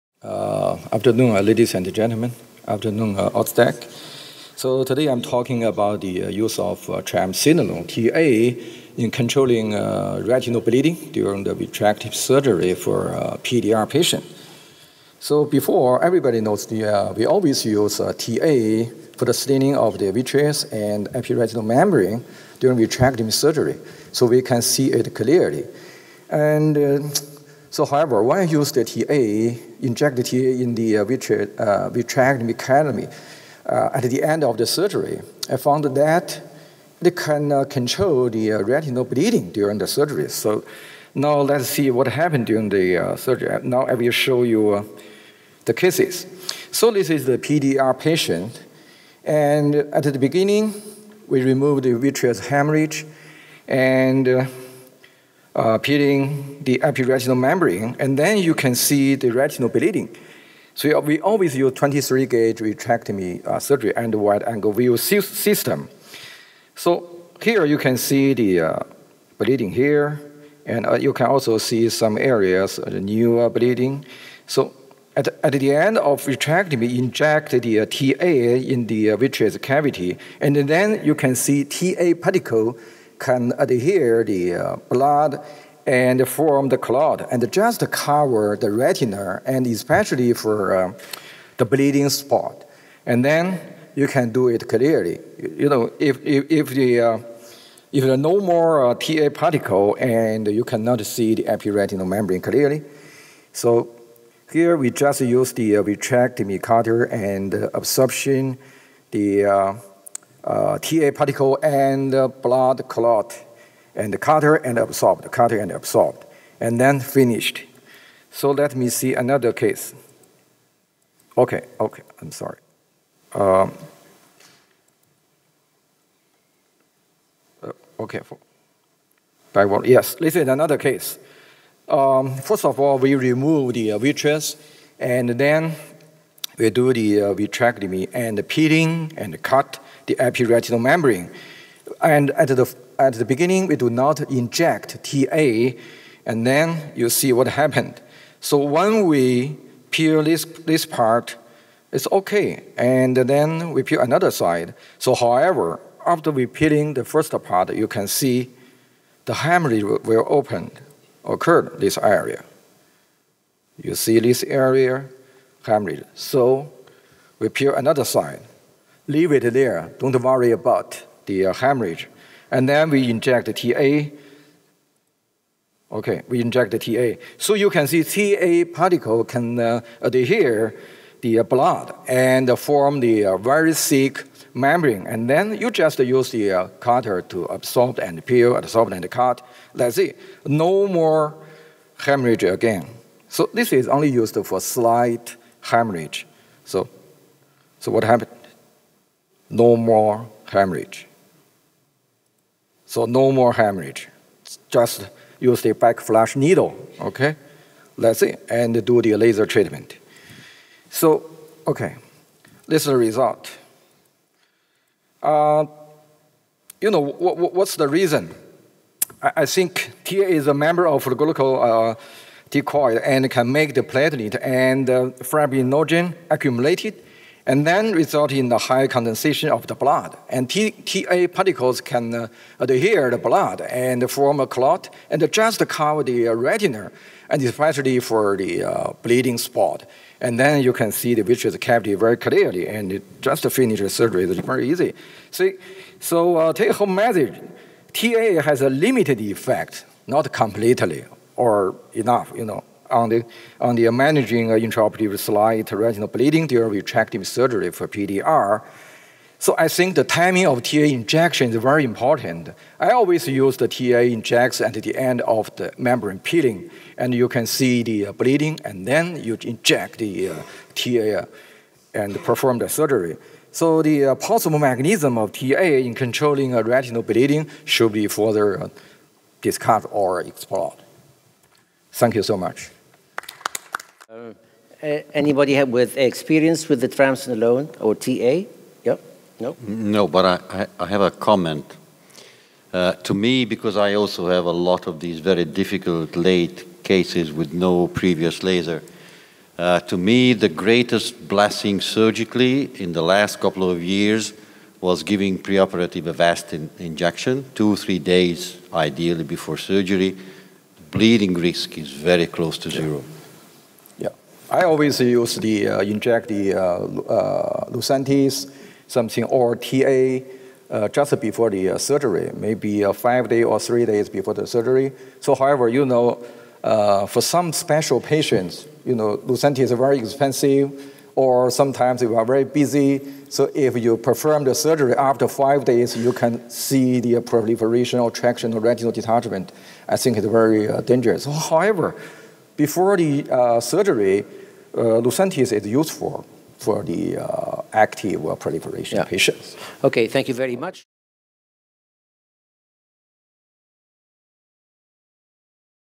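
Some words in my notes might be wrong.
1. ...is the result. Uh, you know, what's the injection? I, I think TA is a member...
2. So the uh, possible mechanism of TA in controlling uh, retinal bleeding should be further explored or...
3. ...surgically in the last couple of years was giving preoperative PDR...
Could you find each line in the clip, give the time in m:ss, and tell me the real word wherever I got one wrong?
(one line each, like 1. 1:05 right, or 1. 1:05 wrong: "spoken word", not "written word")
1. 3:32 wrong: "reason", not "injection"
2. 4:33 wrong: "discussed", not "explored"
3. 5:01 wrong: "Avastin", not "PDR".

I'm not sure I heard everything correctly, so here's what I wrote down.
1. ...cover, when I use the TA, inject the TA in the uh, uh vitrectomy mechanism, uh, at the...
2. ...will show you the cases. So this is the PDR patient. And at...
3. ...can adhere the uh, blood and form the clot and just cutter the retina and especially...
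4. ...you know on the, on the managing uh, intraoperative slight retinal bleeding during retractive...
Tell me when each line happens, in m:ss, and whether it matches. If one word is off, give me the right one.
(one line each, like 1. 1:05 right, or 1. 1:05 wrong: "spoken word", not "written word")
1. 0:27 wrong: "however", not "cover"
2. 0:43 right
3. 1:23 wrong: "cover", not "cutter"
4. 4:12 right.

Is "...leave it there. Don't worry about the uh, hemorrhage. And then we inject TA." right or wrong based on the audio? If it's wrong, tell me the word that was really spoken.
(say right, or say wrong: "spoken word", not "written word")
right.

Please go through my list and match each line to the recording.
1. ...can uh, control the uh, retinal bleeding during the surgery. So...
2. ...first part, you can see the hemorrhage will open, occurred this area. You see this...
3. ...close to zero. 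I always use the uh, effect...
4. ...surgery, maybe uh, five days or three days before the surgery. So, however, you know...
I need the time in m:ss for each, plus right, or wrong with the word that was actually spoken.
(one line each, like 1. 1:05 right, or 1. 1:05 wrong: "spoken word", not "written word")
1. 0:37 right
2. 2:37 right
3. 5:12 wrong: "inject", not "effect"
4. 5:21 right.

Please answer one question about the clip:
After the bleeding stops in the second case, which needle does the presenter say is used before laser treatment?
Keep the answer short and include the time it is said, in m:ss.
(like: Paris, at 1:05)
backflush needle, at 3:25.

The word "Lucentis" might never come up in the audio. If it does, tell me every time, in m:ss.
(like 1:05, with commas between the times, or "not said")
5:17, 5:29, 5:45.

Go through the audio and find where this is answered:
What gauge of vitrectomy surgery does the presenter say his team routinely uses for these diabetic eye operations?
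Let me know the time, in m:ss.
1:01.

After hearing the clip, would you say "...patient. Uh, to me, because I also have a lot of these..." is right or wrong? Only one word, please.
wrong.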